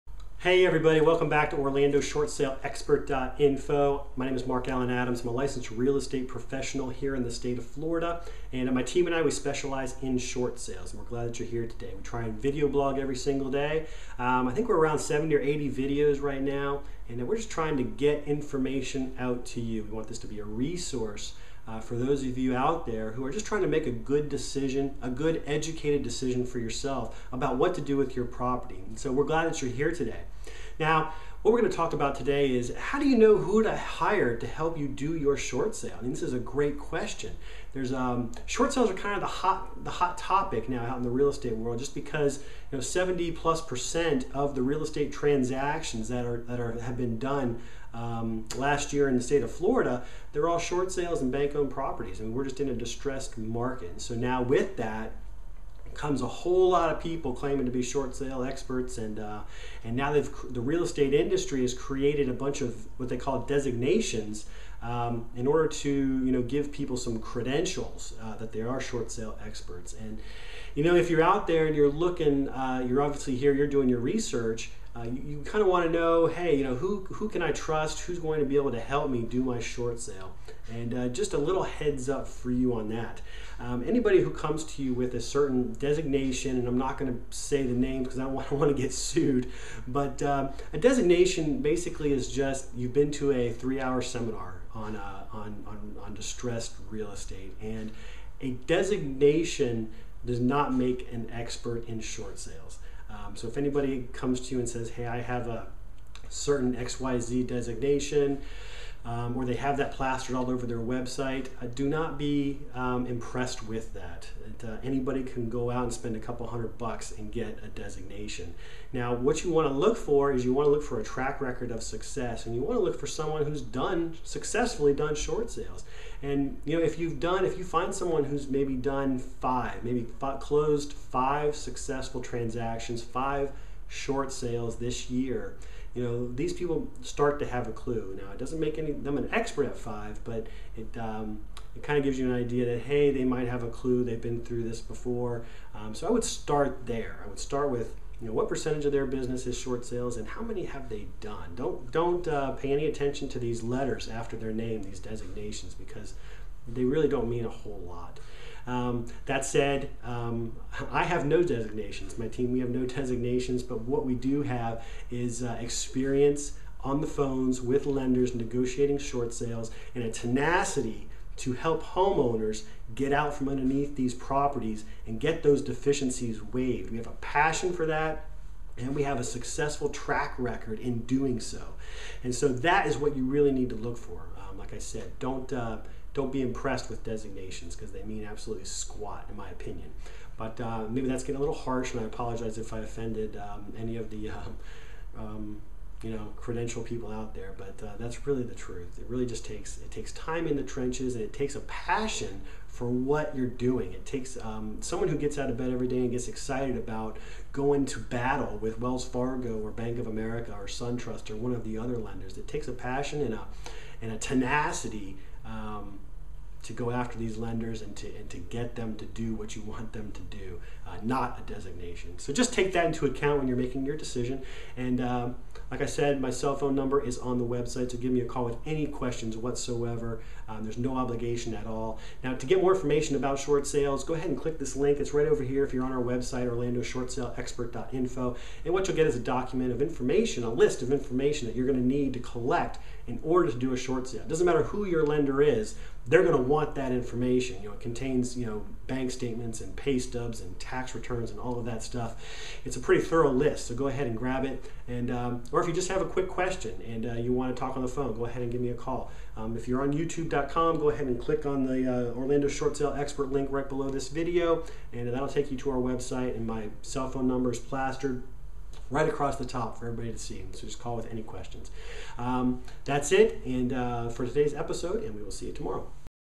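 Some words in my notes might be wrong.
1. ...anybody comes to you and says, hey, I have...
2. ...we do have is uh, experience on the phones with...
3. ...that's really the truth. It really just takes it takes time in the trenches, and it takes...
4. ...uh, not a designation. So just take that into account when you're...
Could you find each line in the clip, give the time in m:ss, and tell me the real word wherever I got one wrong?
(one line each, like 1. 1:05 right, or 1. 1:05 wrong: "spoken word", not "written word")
1. 1:43 right
2. 2:44 right
3. 3:17 right
4. 3:40 right.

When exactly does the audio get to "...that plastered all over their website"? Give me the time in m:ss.
1:49.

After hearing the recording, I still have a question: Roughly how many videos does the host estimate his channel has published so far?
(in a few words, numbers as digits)
70 or 80.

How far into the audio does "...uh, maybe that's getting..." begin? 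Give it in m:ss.
3:10.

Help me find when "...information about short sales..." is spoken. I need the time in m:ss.
3:52.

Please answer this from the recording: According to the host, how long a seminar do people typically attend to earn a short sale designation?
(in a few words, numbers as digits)
three hour.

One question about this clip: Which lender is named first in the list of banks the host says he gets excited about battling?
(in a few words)
Wells Fargo.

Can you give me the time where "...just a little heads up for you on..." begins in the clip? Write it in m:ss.
1:21.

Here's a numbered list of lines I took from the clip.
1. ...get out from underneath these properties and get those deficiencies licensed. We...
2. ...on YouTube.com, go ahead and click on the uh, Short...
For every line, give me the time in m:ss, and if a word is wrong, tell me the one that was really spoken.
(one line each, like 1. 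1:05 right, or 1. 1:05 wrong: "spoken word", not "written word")
1. 2:52 wrong: "waived", not "licensed"
2. 4:19 wrong: "Orlando", not "Short".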